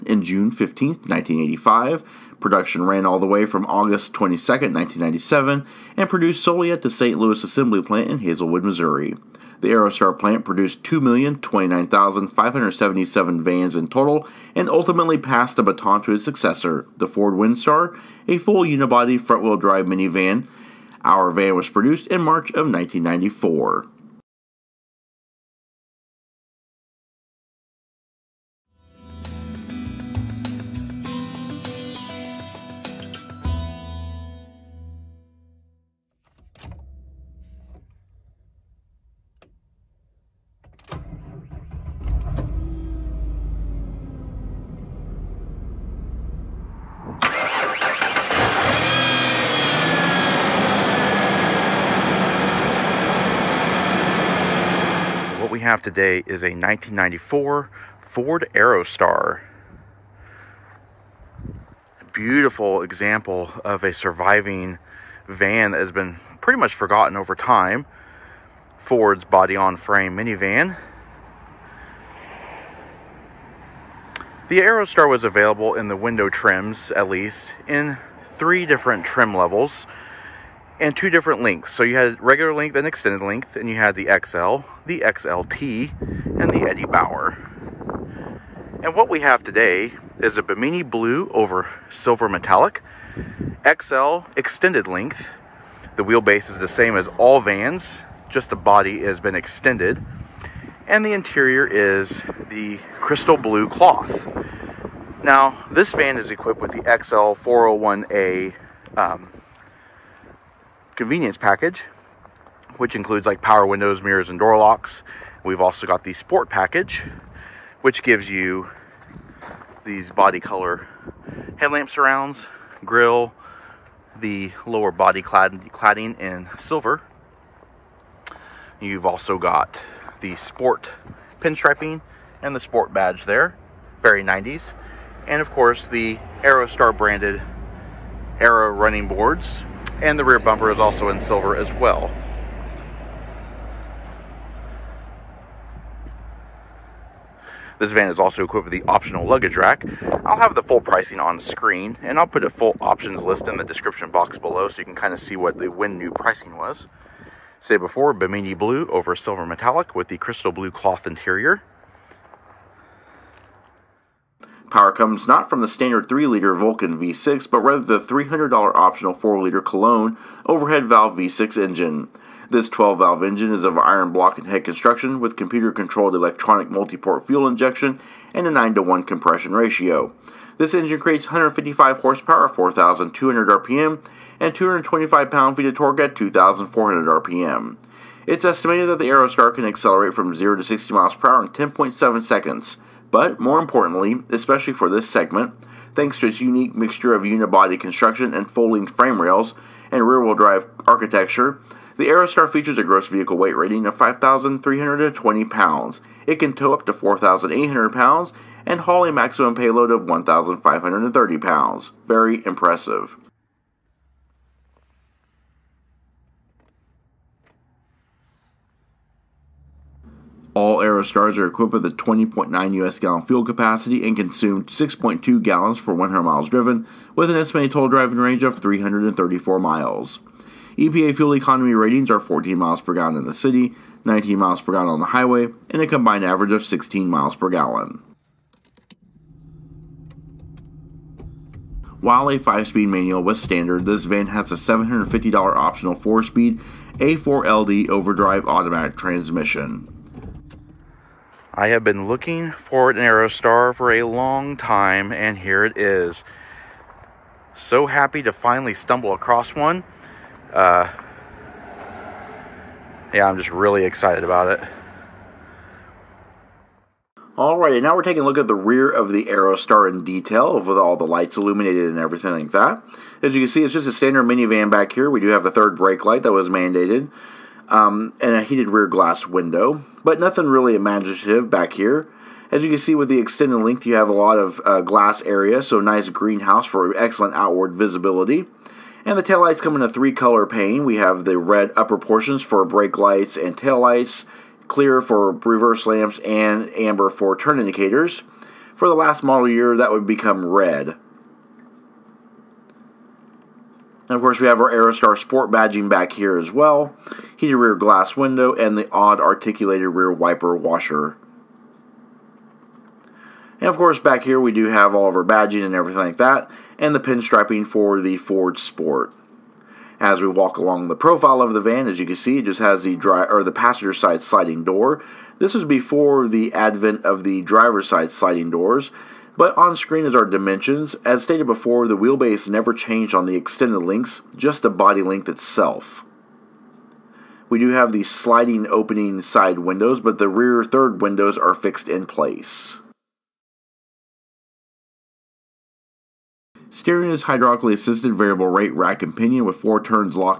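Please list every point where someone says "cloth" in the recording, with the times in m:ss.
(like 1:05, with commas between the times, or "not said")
1:43, 2:40.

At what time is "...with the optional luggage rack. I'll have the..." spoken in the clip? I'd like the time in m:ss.
2:28.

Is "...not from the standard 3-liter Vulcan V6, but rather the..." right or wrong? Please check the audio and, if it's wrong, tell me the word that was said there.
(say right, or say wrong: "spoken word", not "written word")
right.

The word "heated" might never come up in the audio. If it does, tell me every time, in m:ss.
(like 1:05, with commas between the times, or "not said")
4:38, 5:07.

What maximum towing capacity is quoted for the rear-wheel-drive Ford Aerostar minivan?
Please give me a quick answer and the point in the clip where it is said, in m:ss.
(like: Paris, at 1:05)
4,800 pounds, at 3:26.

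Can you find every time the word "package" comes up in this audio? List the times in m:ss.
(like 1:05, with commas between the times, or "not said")
1:51, 1:56.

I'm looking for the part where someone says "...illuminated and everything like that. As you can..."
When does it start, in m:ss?
4:31.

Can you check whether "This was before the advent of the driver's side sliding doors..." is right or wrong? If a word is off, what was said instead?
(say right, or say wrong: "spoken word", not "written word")
right.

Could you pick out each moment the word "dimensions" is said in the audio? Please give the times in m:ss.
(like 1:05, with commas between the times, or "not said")
5:30.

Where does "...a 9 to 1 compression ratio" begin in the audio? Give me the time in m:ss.
2:58.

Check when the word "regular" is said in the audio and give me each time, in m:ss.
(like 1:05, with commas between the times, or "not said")
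1:22.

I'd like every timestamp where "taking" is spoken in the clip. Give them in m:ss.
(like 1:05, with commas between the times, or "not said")
4:28.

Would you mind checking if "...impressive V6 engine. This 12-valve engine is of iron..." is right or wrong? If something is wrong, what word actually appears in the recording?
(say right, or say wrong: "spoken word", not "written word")
wrong: "valve", not "impressive".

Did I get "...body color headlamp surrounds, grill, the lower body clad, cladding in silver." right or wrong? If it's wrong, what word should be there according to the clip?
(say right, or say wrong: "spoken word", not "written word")
right.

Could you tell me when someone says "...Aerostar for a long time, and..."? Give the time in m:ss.
4:12.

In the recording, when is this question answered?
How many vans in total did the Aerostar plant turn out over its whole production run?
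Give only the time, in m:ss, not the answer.
0:10.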